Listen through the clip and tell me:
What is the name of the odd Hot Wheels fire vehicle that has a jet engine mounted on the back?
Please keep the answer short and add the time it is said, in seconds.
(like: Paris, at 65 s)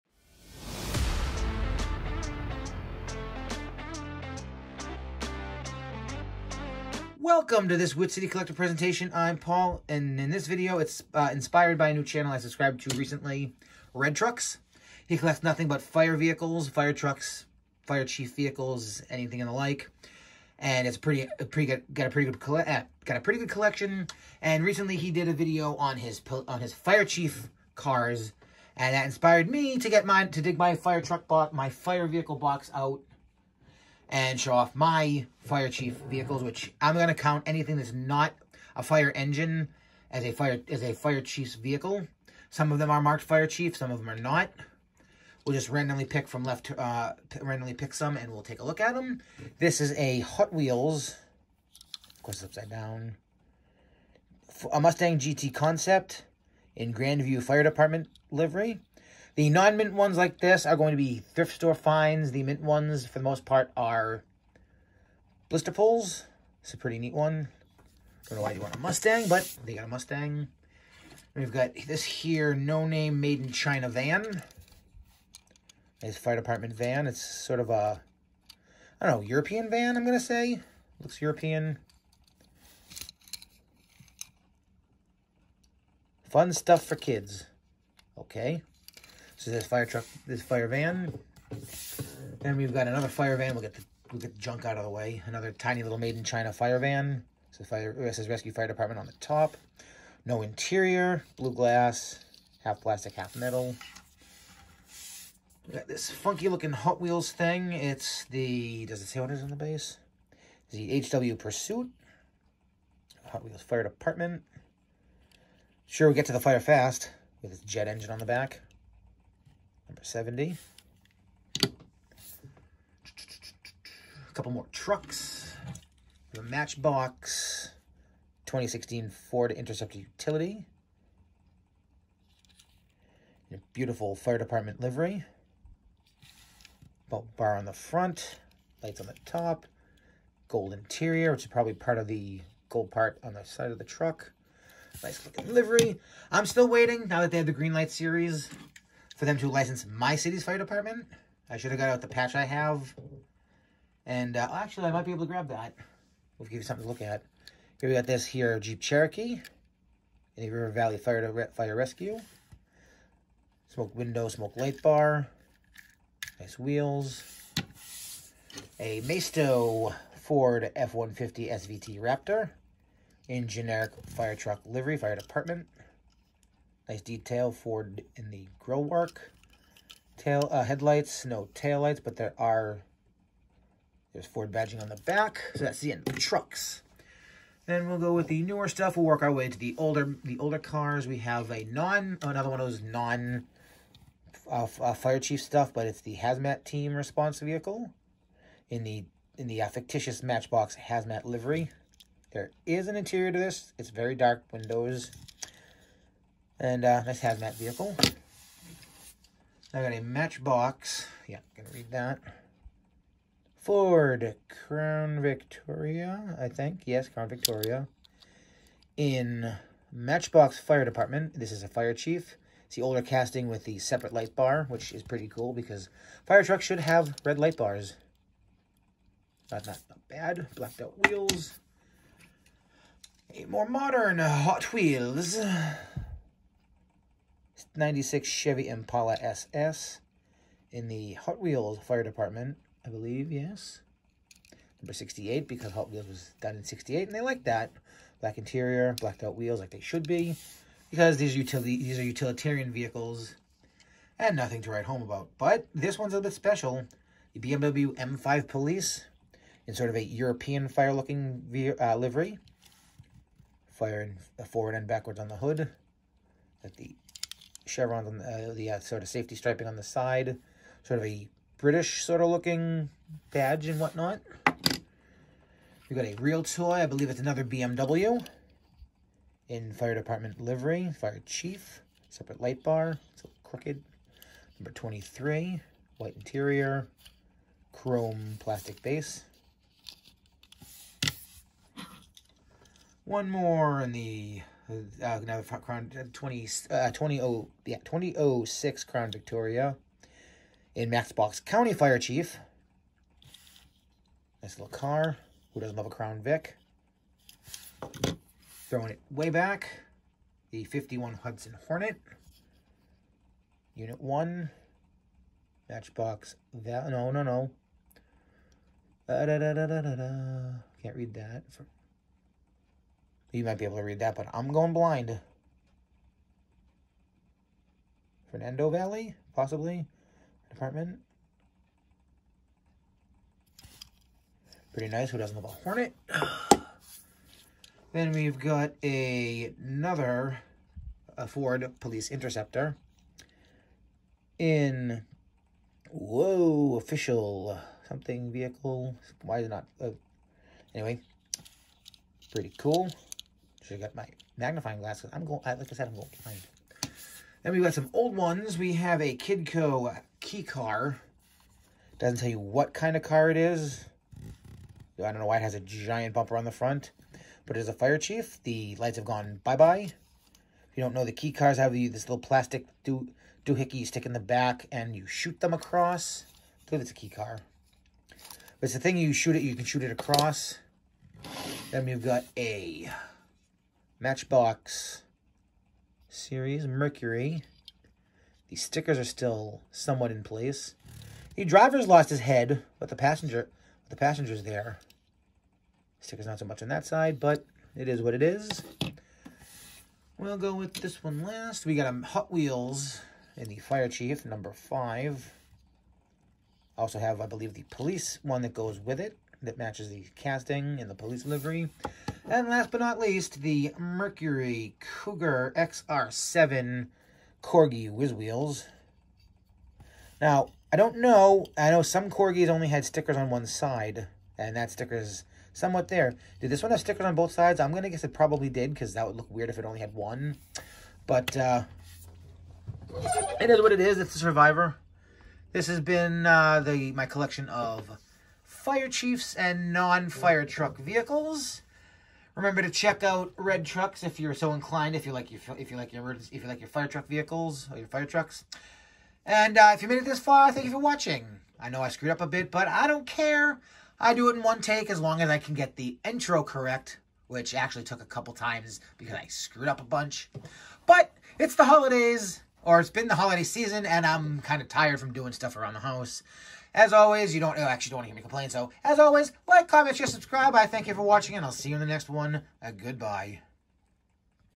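HW Pursuit, at 111 s.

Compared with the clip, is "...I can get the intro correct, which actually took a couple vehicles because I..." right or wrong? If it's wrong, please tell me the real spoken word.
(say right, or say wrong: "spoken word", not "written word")
wrong: "times", not "vehicles".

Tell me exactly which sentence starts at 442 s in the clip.
Remember to check out red trucks if you're so inclined.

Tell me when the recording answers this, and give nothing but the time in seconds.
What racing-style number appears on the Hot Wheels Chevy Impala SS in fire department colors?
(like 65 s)
244 s.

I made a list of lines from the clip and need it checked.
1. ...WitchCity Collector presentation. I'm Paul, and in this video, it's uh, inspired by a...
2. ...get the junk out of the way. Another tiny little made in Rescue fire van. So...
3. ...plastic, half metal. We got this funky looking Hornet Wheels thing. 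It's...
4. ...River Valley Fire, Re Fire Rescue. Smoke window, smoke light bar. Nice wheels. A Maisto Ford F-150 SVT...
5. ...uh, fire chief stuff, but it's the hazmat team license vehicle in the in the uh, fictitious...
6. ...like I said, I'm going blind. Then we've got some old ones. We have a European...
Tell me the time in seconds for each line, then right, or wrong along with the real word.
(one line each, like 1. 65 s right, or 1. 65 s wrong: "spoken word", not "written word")
1. 7 s right
2. 94 s wrong: "China", not "Rescue"
3. 102 s wrong: "Hot", not "Hornet"
4. 160 s right
5. 194 s wrong: "response", not "license"
6. 355 s wrong: "Kidco", not "European".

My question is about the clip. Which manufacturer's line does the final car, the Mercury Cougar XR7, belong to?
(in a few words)
Corgi Whiz Wheels.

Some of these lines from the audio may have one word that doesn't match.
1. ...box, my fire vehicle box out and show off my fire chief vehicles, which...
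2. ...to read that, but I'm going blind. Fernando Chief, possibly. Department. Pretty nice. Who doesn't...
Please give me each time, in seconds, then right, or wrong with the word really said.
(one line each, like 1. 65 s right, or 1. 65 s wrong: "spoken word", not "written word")
1. 31 s right
2. 323 s wrong: "Valley", not "Chief".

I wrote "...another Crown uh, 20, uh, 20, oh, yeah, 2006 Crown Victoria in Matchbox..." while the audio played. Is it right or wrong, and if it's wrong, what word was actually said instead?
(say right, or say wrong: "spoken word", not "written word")
right.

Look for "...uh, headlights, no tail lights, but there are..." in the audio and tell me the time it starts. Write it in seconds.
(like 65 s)
180 s.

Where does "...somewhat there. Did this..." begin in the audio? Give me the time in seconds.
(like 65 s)
425 s.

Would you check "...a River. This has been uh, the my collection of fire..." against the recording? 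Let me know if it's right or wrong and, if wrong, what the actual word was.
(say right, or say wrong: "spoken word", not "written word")
wrong: "Survivor", not "River".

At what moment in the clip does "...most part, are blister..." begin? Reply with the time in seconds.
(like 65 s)
63 s.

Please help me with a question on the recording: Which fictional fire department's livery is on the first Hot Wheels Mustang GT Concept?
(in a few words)
Grandview Fire Department.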